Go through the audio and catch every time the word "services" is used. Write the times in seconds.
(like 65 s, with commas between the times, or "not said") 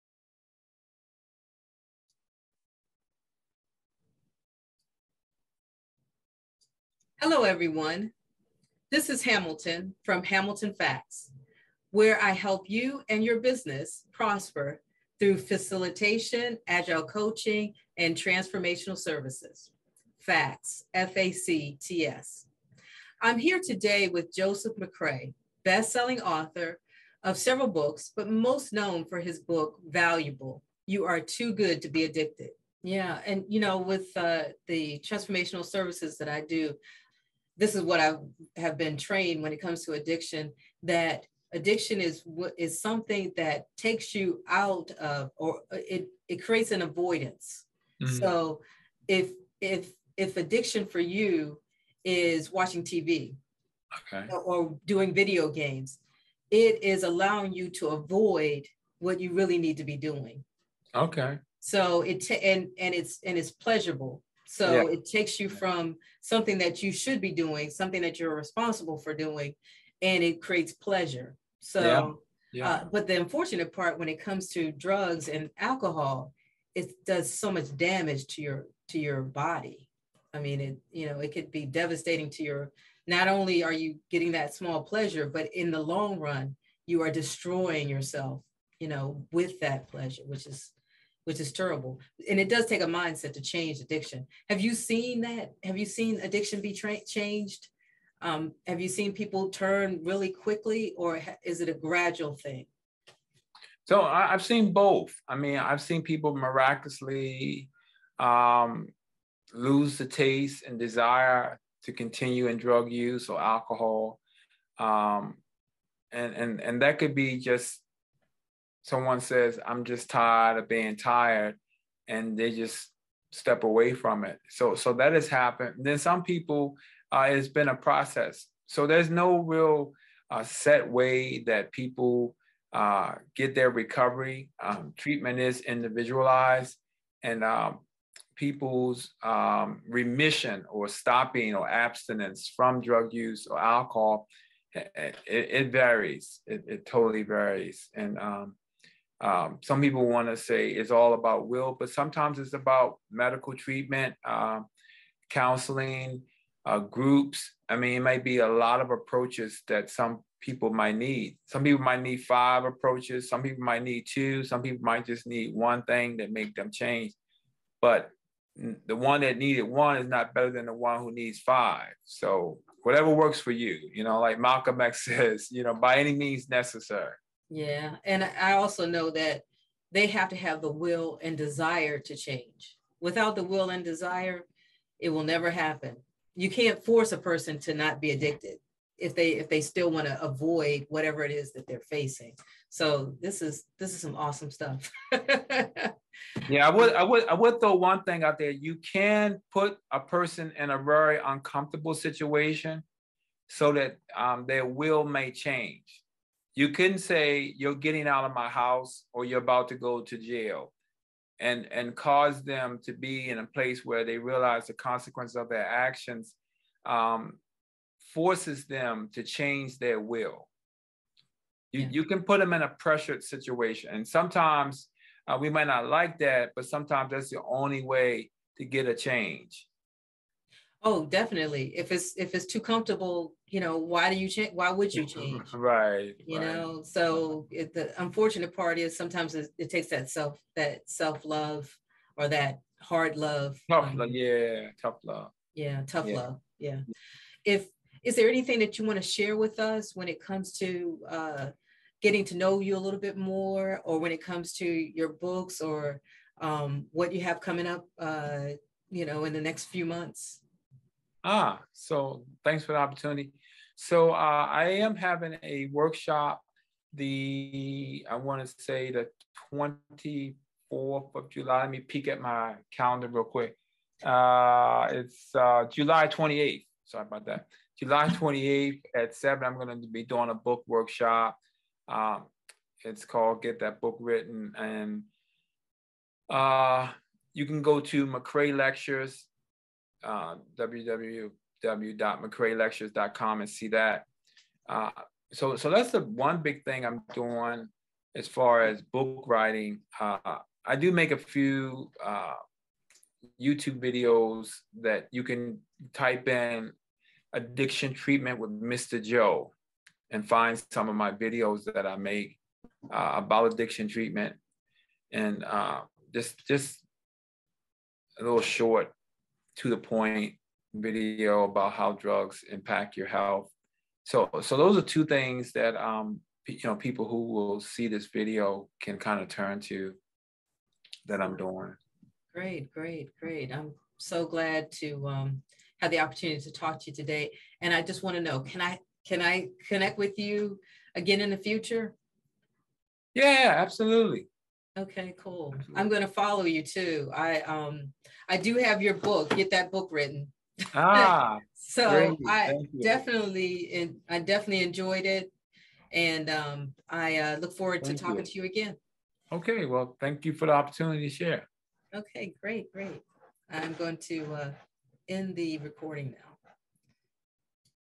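18 s, 35 s.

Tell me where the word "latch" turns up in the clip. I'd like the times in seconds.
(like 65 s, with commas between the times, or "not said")
not said.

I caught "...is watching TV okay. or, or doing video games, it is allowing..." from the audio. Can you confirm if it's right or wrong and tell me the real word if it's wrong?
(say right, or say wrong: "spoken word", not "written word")
right.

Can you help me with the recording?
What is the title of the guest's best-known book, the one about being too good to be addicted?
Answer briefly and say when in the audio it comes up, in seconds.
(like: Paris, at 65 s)
Valuable, at 29 s.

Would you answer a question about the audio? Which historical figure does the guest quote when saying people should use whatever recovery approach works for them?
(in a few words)
Malcolm X.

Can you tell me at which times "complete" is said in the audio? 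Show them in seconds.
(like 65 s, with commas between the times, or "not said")
not said.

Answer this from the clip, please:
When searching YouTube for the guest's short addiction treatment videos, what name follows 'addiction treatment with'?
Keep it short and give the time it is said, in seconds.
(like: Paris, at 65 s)
Mr. Joe, at 308 s.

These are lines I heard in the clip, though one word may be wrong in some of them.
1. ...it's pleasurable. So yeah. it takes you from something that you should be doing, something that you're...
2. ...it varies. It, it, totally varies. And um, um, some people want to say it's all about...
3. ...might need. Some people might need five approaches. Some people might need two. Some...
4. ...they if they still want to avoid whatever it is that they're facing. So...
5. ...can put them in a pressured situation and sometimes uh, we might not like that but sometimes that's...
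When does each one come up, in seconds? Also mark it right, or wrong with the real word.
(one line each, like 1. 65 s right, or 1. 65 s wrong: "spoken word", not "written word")
1. 63 s right
2. 145 s right
3. 160 s right
4. 189 s right
5. 222 s right.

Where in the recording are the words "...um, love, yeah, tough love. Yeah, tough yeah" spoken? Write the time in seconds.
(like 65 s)
243 s.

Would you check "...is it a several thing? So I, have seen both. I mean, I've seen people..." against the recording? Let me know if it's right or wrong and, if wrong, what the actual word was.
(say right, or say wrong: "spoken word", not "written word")
wrong: "gradual", not "several".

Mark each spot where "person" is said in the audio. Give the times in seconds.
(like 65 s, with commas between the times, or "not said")
187 s, 199 s.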